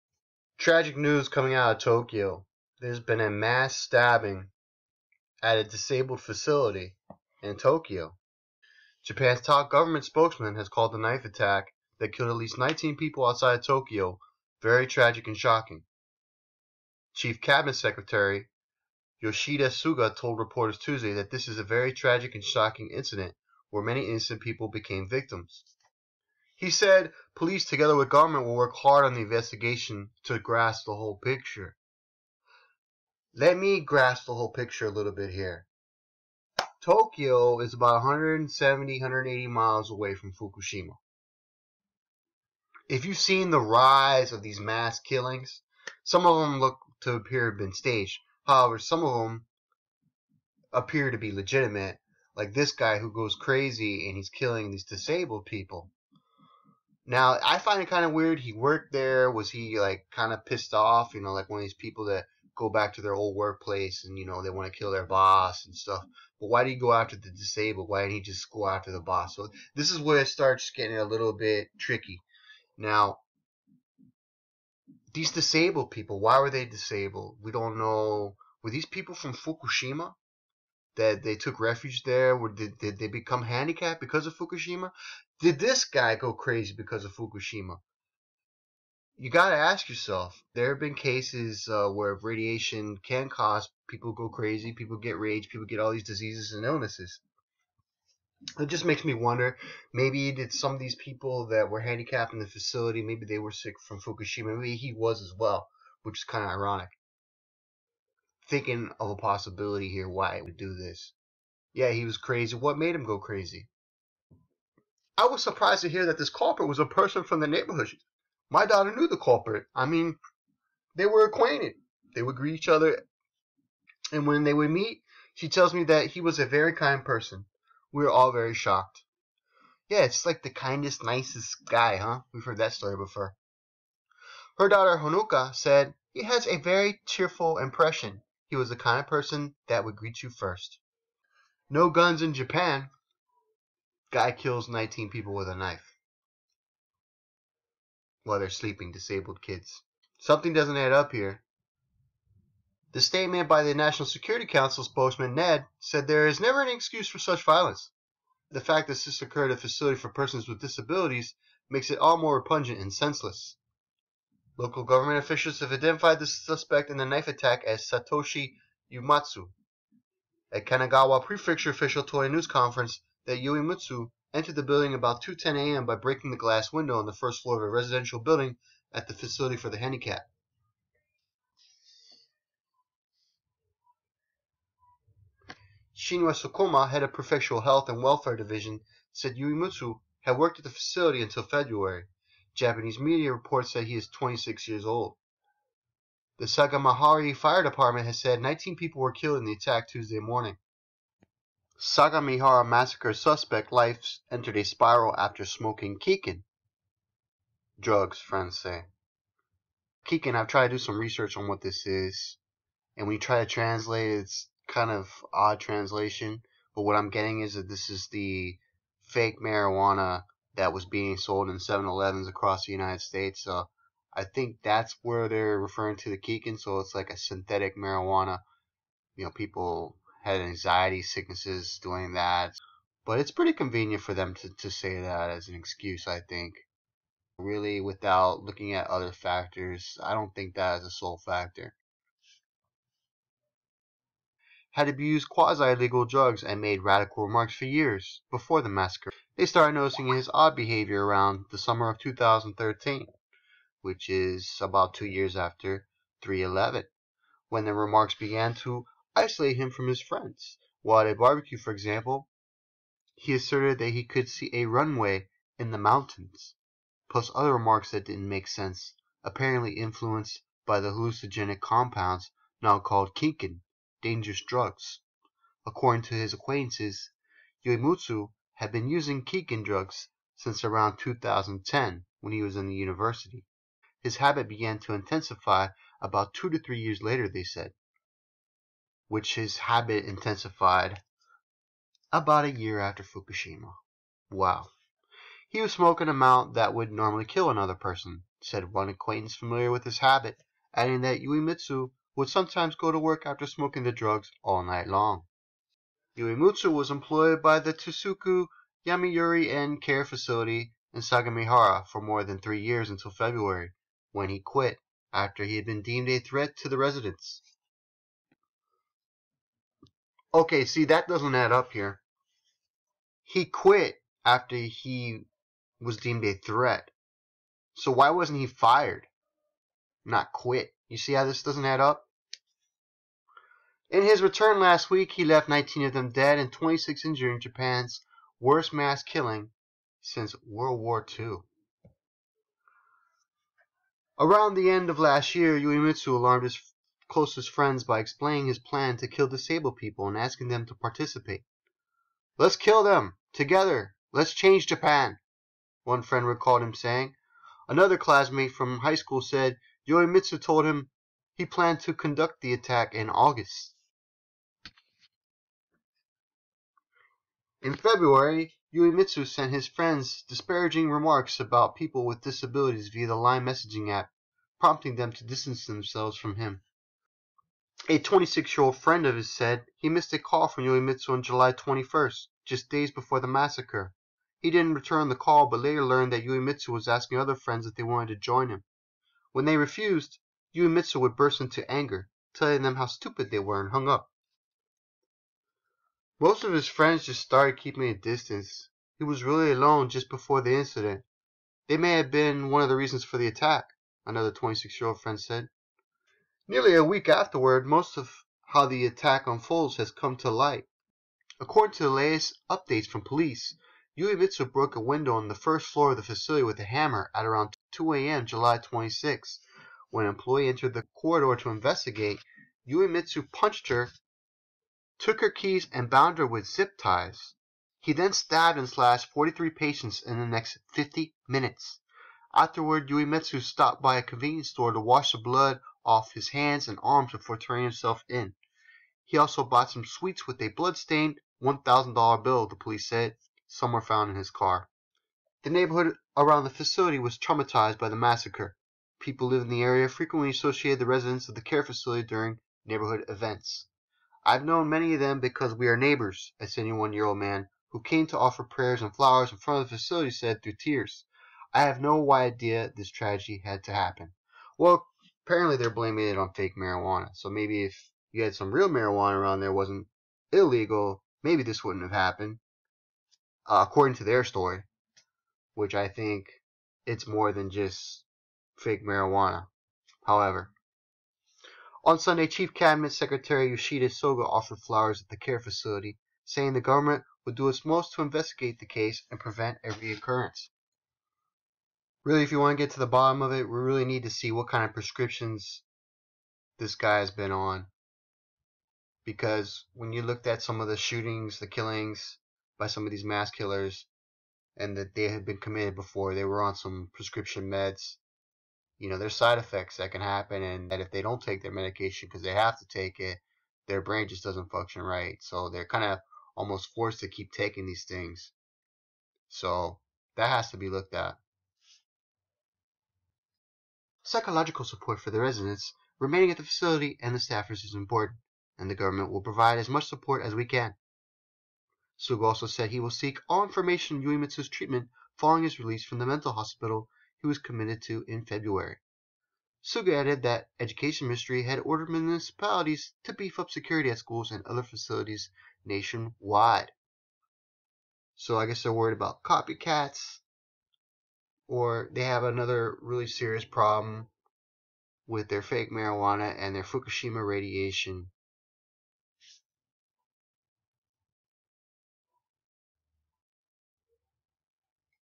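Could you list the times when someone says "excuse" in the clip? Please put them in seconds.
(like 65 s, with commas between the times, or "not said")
156 s, 235 s.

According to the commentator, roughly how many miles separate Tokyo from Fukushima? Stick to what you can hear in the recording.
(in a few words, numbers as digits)
170, 180 miles.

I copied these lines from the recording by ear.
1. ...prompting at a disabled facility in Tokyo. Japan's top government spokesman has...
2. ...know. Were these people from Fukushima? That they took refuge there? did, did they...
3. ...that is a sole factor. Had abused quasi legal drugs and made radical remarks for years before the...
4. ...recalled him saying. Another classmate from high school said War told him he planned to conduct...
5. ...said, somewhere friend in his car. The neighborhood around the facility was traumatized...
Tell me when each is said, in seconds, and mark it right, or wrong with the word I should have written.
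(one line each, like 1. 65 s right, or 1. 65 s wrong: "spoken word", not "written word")
1. 3 s wrong: "stabbing", not "prompting"
2. 77 s right
3. 240 s right
4. 356 s wrong: "Uematsu", not "War"
5. 442 s wrong: "found", not "friend".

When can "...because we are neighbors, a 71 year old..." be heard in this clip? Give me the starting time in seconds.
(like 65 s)
455 s.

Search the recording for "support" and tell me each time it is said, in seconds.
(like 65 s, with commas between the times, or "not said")
524 s, 529 s.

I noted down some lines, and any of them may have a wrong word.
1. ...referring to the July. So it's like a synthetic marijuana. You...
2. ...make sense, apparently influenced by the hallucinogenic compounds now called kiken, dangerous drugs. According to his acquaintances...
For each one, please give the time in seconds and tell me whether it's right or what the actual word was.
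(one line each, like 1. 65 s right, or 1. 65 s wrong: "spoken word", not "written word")
1. 225 s wrong: "Kiken", not "July"
2. 268 s right.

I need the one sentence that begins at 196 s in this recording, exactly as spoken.
The Sagamihara Fire Department has said 19 people were killed in the attack Tuesday morning.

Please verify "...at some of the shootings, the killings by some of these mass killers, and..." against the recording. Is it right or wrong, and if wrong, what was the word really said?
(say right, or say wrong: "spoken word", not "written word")
right.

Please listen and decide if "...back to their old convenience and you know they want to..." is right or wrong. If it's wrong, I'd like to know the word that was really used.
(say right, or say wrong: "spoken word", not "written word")
wrong: "workplace", not "convenience".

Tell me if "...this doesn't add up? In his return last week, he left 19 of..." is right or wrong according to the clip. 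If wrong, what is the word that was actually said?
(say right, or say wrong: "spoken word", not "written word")
right.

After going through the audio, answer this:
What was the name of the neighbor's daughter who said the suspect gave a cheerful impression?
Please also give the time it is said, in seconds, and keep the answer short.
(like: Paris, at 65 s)
Honoka, at 134 s.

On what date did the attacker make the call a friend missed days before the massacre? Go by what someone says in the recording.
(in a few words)
July 21st.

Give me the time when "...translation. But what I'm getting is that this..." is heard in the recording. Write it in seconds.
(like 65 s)
215 s.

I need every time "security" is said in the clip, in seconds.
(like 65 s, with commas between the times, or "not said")
154 s, 543 s.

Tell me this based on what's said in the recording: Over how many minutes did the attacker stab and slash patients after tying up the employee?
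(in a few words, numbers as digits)
50 minutes.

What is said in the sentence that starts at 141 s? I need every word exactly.
No guns in Japan, Guy kills 19 people with a knife while they're sleeping, disabled kids.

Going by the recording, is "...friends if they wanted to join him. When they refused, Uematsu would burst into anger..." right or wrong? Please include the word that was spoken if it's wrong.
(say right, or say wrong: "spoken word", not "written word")
right.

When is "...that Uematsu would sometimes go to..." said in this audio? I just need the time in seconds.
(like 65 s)
301 s.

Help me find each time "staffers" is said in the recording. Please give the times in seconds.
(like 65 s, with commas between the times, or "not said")
527 s.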